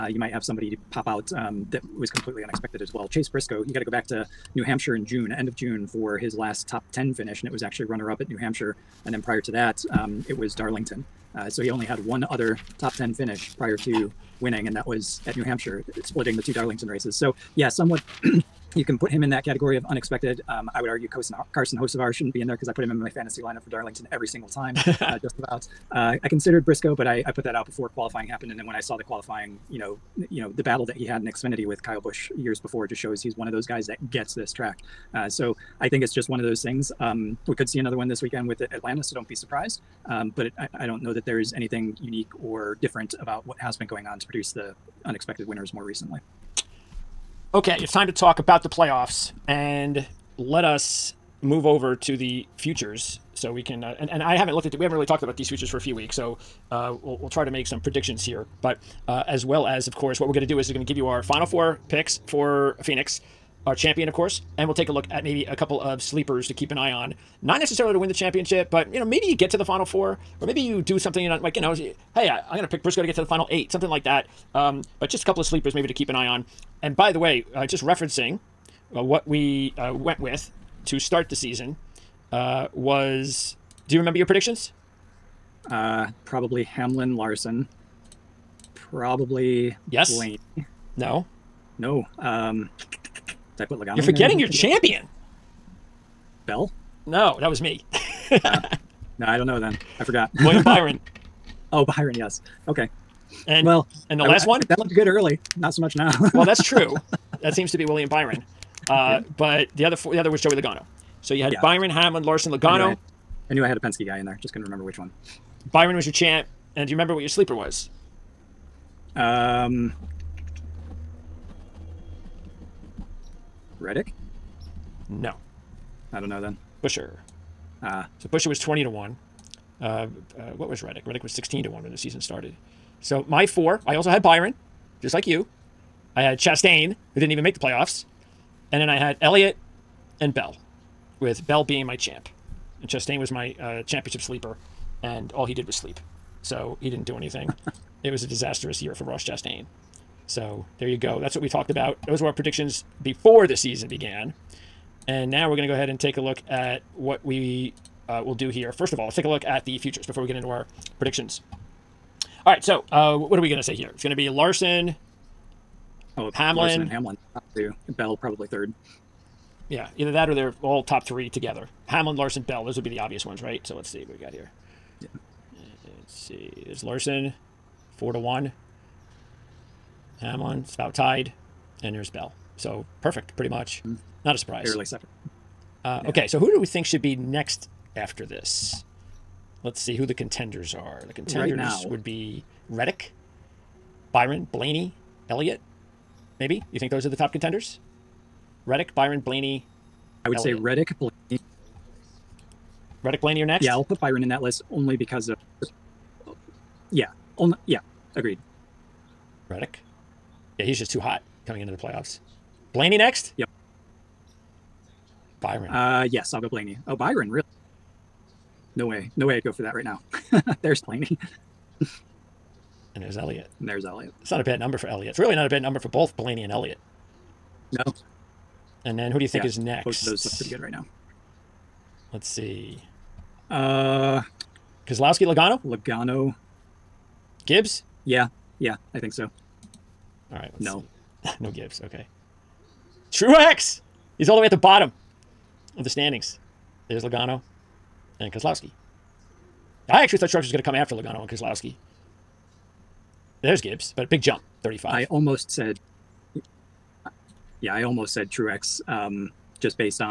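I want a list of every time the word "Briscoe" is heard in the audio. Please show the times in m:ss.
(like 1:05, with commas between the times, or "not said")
0:03, 0:26, 1:12.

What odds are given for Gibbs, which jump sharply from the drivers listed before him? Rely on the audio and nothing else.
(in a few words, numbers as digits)
35.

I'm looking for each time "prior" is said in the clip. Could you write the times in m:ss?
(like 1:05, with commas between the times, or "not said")
0:09, 0:13.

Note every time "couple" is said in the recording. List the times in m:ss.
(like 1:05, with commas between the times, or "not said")
1:05, 1:15.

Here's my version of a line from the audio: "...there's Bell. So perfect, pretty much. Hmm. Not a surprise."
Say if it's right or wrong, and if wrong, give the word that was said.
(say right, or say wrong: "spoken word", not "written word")
right.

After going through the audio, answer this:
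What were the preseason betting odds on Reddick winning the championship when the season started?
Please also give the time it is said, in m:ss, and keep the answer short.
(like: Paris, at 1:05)
16 to 1, at 2:11.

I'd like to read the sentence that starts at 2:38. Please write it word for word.
First of all, let's take a look at the futures before we get into our predictions.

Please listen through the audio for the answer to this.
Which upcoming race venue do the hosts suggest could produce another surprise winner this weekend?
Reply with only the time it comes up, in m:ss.
0:38.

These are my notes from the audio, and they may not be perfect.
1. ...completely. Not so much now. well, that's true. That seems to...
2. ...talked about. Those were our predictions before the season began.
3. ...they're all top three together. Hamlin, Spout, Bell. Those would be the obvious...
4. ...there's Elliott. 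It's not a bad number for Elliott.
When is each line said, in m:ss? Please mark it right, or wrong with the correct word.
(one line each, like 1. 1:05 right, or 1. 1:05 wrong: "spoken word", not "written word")
1. 1:45 wrong: "early", not "completely"
2. 2:31 right
3. 2:50 wrong: "Larson", not "Spout"
4. 3:43 right.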